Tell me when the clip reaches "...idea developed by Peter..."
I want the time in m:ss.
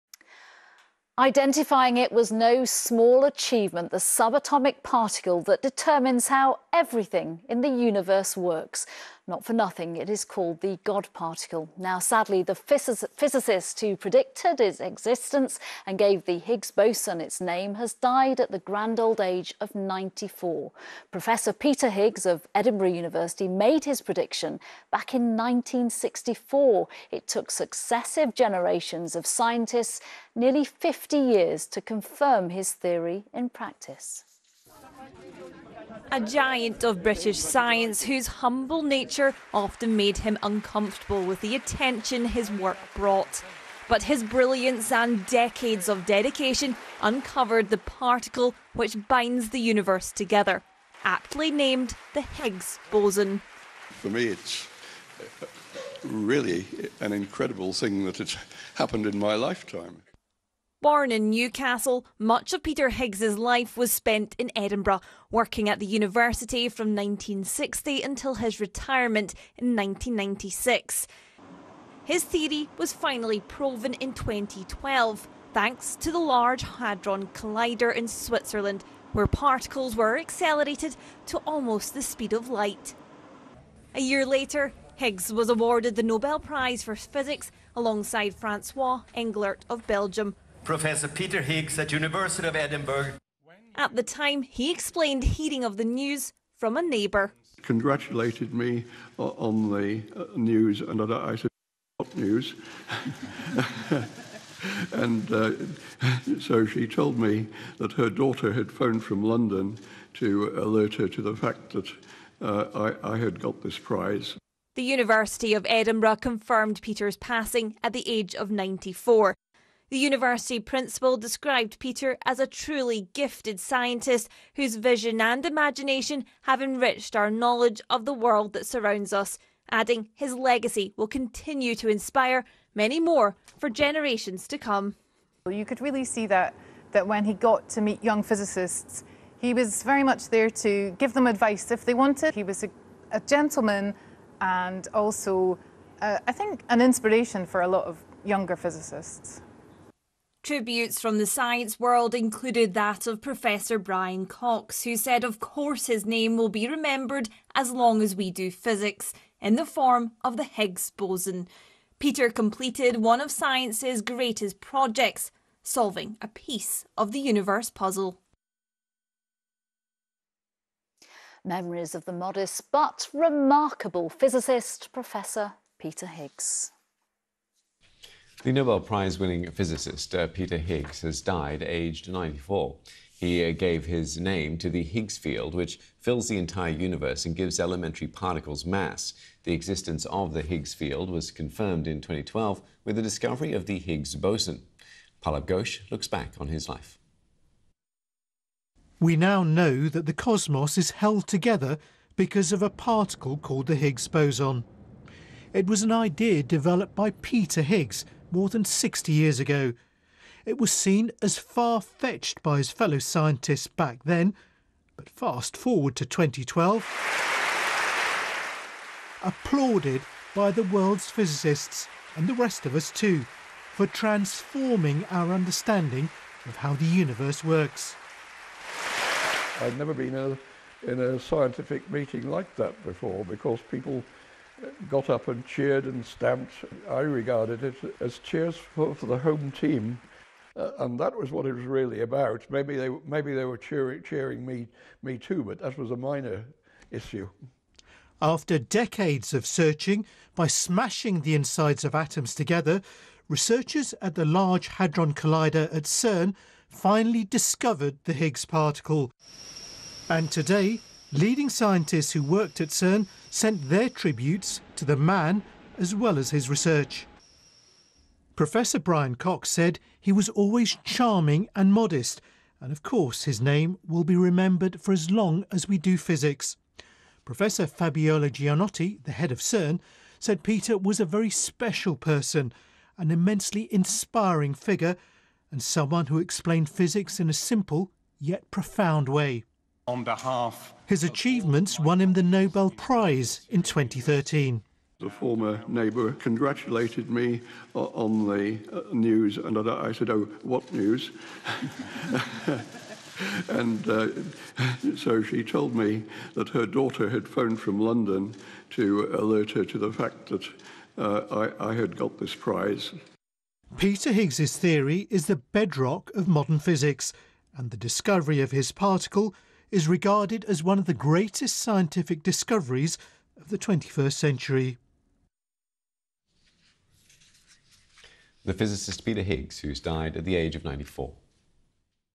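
3:25.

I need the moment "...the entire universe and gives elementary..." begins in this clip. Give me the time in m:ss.
3:06.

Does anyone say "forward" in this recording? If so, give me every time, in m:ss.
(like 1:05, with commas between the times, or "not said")
3:35.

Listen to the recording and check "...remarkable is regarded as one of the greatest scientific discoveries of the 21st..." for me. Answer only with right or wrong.
wrong.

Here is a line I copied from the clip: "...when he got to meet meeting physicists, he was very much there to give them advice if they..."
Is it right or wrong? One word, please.
wrong.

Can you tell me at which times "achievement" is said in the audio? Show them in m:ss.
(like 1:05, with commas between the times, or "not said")
0:03, 4:51.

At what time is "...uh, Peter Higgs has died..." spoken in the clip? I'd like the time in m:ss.
3:00.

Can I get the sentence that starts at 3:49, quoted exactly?
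I'd never been in a, in a scientific meeting like that before because people got up and cheered and stamped.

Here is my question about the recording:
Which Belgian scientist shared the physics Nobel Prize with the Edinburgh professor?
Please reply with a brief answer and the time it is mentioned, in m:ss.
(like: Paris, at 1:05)
Francois Englert, at 1:28.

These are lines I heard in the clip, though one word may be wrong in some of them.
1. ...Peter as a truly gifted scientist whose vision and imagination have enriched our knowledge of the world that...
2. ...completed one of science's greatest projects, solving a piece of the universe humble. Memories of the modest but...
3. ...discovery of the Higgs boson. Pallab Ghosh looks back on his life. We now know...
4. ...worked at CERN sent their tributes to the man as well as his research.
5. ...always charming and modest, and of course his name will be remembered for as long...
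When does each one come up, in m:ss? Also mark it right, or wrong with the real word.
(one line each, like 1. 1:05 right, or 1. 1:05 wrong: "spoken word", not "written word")
1. 2:01 right
2. 2:42 wrong: "puzzle", not "humble"
3. 3:13 right
4. 4:22 right
5. 4:30 right.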